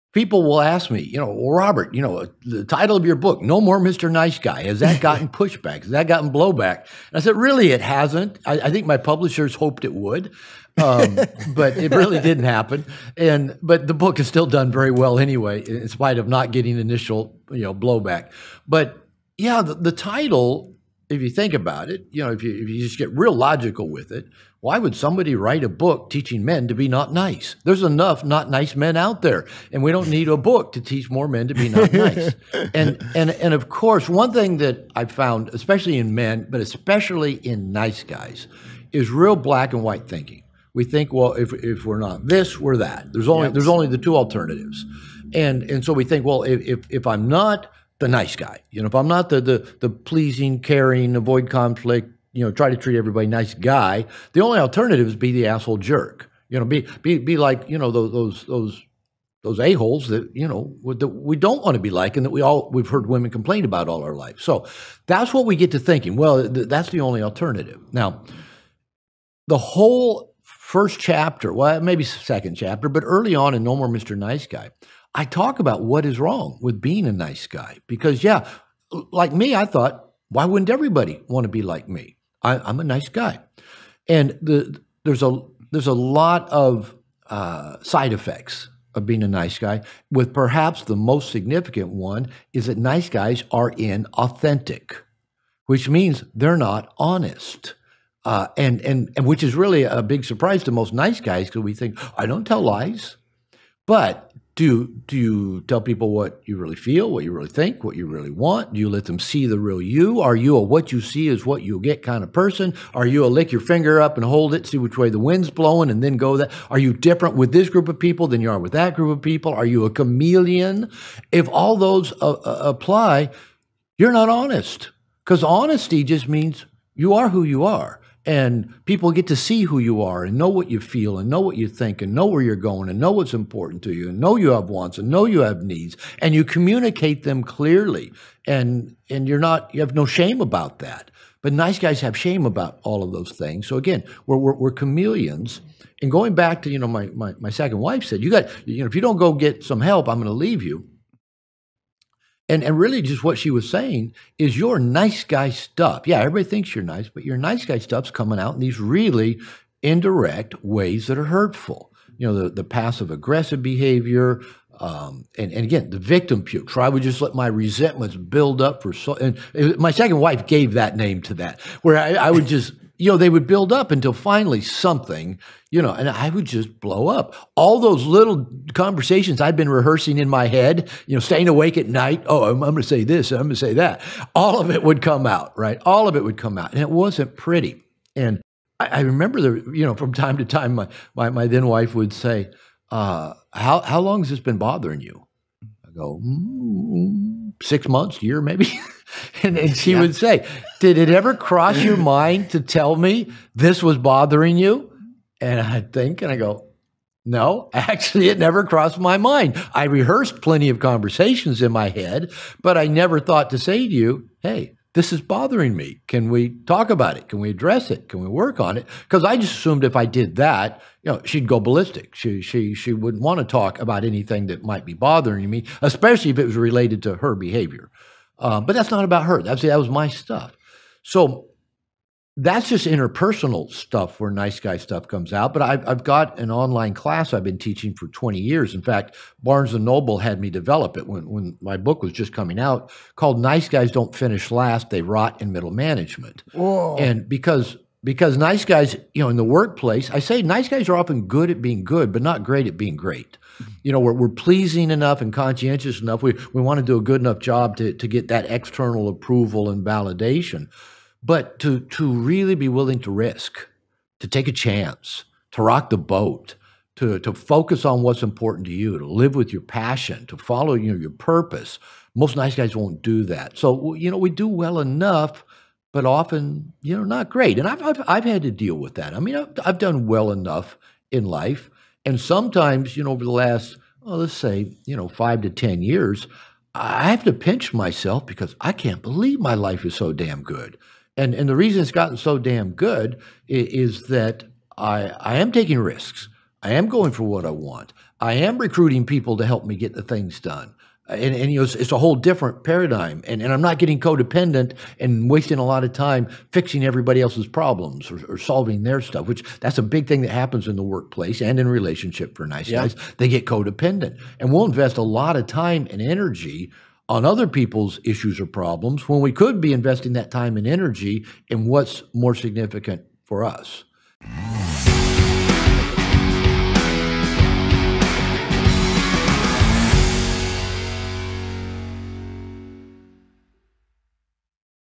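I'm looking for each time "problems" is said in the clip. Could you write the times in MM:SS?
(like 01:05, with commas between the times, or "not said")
05:07, 05:18.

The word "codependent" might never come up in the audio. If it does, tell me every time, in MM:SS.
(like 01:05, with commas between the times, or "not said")
05:03, 05:13.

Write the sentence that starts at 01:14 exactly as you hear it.
Nice Guy, I talk about what is wrong with being a nice guy.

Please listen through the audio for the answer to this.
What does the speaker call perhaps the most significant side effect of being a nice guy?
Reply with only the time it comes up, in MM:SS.
01:33.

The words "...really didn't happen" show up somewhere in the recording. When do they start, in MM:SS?
00:11.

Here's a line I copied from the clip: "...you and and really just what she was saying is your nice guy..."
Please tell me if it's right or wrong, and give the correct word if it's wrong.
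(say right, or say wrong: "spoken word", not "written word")
right.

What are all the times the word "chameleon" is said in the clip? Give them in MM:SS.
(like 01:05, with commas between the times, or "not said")
01:59, 02:24.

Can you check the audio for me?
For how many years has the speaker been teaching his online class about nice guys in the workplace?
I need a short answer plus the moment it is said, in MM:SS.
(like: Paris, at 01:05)
20, at 03:58.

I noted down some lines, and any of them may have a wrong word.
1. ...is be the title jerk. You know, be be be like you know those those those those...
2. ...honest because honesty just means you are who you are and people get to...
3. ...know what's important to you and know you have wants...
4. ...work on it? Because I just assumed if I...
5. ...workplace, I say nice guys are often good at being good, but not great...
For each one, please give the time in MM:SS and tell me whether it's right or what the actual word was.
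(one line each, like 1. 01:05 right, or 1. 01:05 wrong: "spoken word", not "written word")
1. 00:55 wrong: "asshole", not "title"
2. 02:04 right
3. 02:12 right
4. 03:38 right
5. 04:09 right.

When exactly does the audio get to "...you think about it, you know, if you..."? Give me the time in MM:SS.
00:21.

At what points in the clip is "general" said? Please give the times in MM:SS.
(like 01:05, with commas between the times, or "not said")
not said.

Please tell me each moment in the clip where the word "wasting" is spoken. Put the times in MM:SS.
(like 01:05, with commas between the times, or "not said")
05:05.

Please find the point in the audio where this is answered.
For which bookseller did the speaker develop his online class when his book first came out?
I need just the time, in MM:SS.
03:59.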